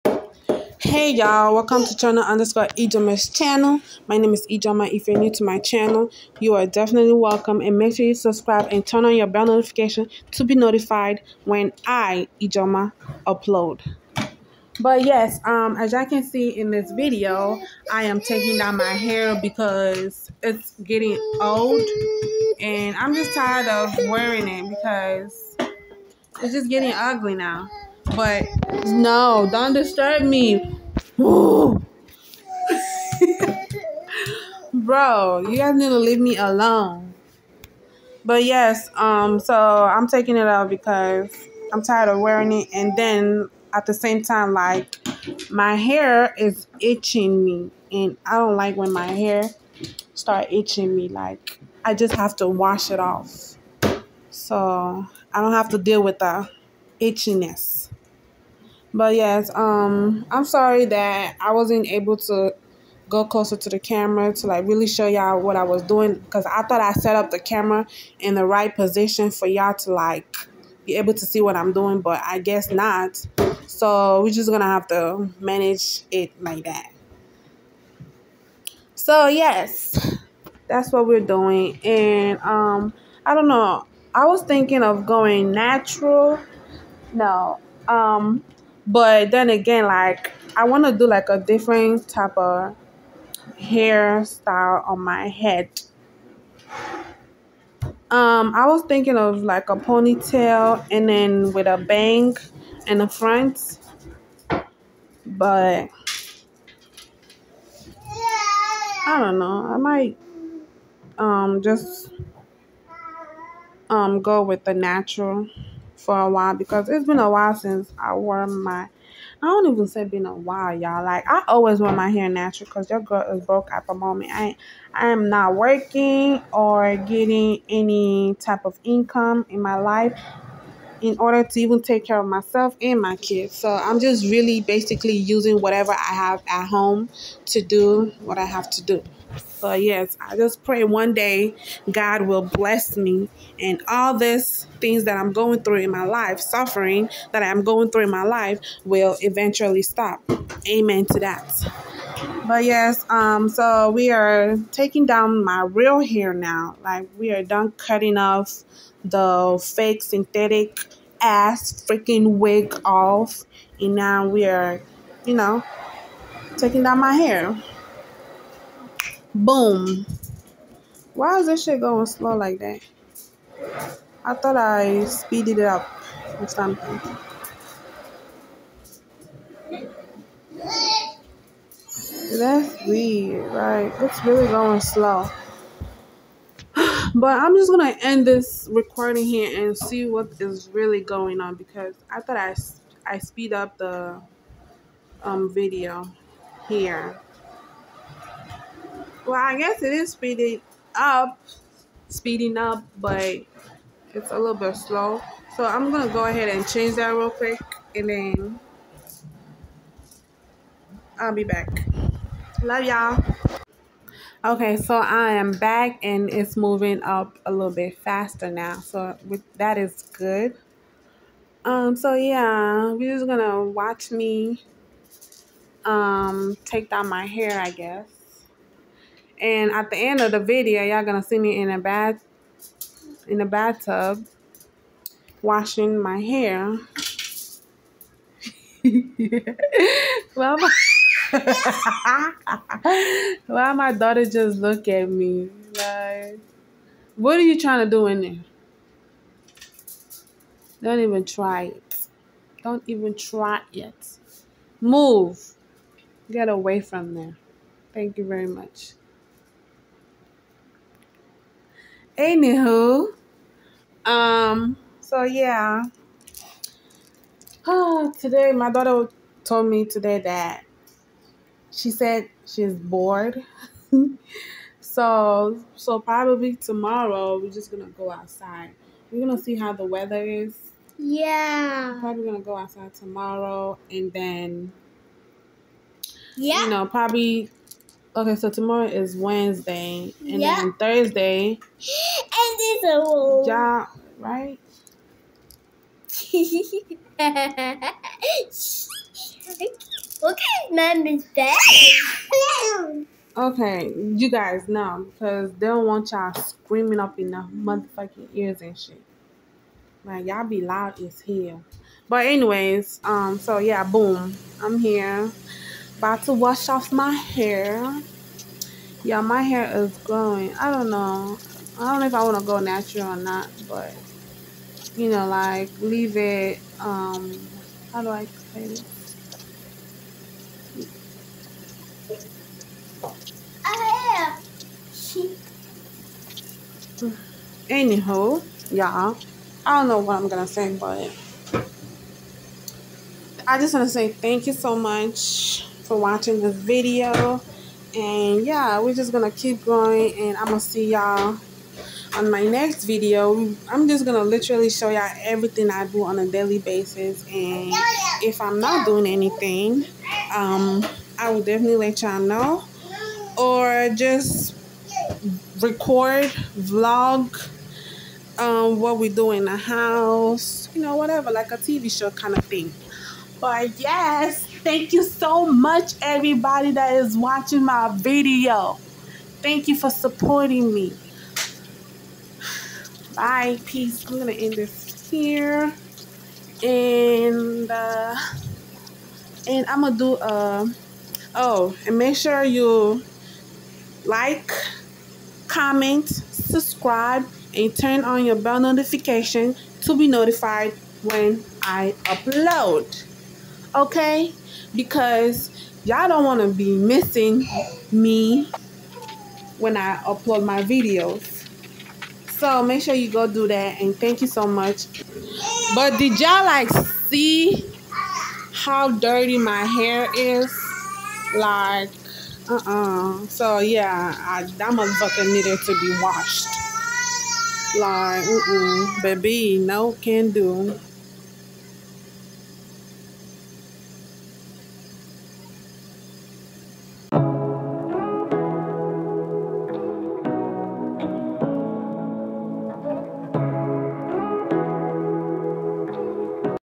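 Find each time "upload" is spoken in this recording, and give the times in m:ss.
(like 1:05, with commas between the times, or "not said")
0:13, 6:42, 6:49.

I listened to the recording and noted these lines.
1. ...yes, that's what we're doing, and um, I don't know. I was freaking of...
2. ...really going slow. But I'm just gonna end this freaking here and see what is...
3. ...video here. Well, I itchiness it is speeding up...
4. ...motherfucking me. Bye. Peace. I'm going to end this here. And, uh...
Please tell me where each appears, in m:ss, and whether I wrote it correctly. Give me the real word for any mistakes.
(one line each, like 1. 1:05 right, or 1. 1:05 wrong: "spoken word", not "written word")
1. 1:19 wrong: "thinking", not "freaking"
2. 3:04 wrong: "recording", not "freaking"
3. 3:15 wrong: "guess", not "itchiness"
4. 6:19 wrong: "supporting", not "motherfucking".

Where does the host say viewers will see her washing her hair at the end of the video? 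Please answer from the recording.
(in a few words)
Bathtub.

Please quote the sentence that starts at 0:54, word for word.
So I don't have to deal with the itchiness.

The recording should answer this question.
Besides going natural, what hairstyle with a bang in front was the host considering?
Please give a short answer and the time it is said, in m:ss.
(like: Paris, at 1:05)
Ponytail, at 1:39.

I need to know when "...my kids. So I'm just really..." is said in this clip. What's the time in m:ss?
2:13.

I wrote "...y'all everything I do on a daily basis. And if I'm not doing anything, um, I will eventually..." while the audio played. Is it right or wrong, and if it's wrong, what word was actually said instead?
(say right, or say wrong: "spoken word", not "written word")
wrong: "definitely", not "eventually".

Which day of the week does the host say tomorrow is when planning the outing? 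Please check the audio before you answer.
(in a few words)
Wednesday.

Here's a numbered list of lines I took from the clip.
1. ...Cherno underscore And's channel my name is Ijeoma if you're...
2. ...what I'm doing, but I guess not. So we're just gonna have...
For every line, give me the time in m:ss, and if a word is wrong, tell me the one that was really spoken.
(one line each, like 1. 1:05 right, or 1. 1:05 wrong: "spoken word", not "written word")
1. 0:01 wrong: "Ijeoma", not "And"
2. 1:11 right.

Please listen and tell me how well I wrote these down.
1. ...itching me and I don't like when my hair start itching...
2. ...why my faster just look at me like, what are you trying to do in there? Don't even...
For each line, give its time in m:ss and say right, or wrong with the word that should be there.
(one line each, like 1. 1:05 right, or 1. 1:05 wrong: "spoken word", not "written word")
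1. 0:46 right
2. 4:03 wrong: "daughter", not "faster".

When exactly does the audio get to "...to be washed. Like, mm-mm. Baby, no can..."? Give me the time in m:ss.
7:05.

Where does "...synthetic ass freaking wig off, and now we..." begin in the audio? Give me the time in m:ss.
2:40.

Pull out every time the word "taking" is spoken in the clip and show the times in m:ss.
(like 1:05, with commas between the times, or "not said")
0:18, 0:40, 2:34, 2:46.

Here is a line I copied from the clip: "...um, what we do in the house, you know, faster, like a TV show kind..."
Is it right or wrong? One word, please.
wrong.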